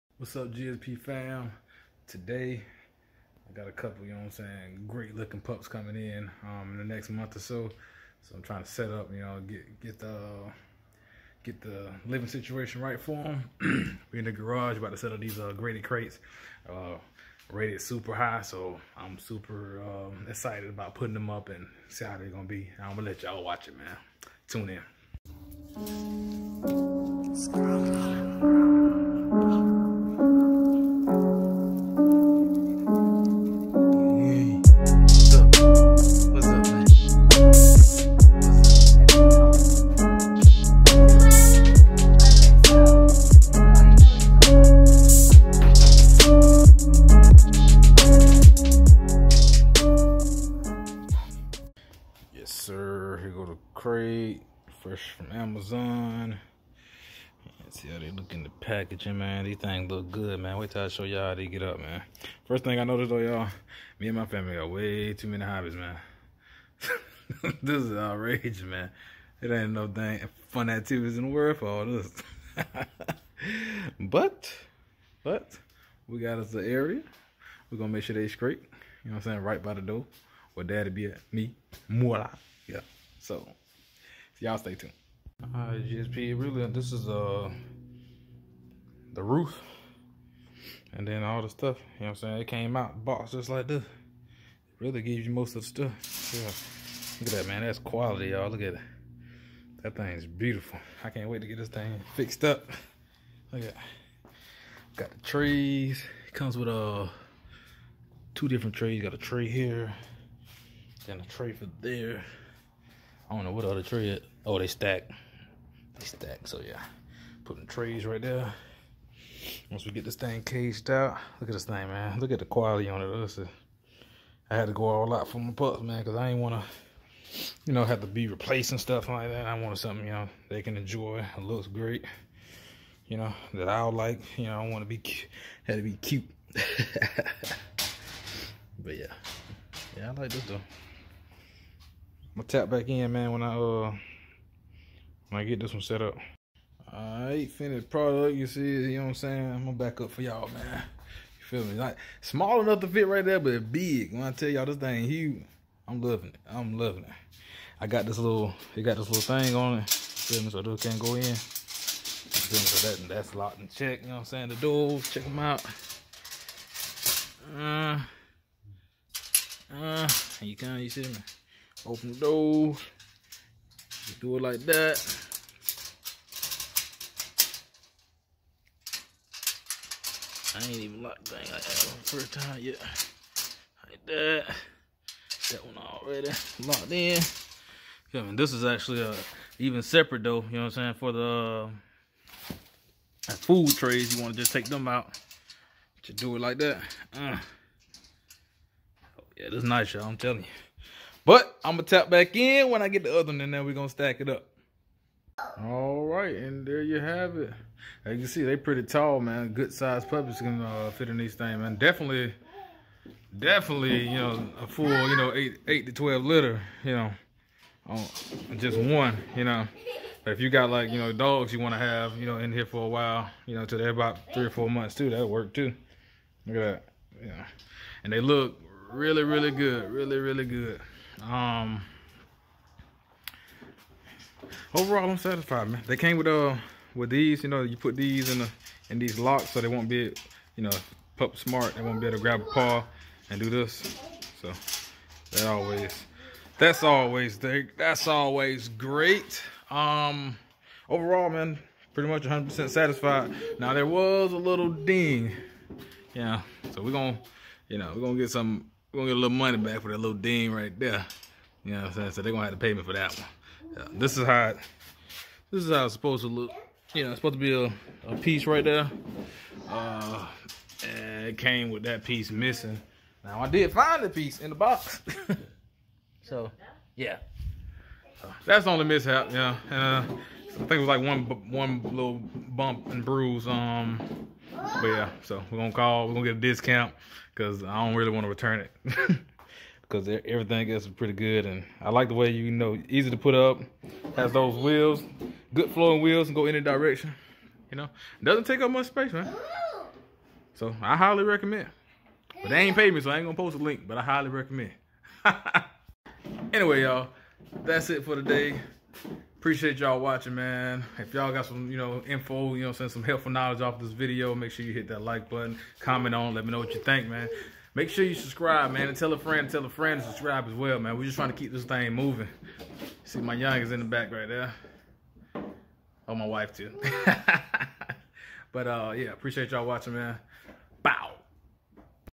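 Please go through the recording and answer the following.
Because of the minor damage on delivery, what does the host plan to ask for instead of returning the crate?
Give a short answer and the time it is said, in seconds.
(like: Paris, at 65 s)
a discount, at 286 s.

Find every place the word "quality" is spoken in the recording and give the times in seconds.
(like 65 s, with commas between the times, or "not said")
97 s, 122 s.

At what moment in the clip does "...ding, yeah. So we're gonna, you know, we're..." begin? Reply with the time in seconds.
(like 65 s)
254 s.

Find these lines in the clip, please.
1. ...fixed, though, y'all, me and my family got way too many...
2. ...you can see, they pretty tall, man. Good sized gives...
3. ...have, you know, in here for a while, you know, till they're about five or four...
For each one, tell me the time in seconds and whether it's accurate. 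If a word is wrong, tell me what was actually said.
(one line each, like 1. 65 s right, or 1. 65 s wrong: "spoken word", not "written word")
1. 62 s wrong: "noticed", not "fixed"
2. 208 s wrong: "puppies", not "gives"
3. 221 s wrong: "three", not "five".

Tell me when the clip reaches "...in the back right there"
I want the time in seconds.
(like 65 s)
323 s.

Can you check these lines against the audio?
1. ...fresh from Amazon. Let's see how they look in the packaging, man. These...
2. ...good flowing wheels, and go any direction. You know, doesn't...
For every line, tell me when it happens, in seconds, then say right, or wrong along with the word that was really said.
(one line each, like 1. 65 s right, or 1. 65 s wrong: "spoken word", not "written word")
1. 54 s right
2. 295 s right.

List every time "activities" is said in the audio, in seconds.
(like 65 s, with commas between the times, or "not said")
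70 s.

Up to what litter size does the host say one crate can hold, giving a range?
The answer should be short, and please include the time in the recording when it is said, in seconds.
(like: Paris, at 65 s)
8 to 12, at 215 s.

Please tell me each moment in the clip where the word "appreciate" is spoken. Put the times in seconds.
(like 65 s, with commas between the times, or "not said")
309 s, 329 s.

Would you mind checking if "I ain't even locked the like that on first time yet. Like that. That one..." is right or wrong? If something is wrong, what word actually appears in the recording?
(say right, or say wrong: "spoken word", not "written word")
right.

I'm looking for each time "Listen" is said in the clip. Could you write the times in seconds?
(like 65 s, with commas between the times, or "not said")
123 s.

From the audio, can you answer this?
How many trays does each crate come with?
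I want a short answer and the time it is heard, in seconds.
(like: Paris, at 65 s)
2, at 108 s.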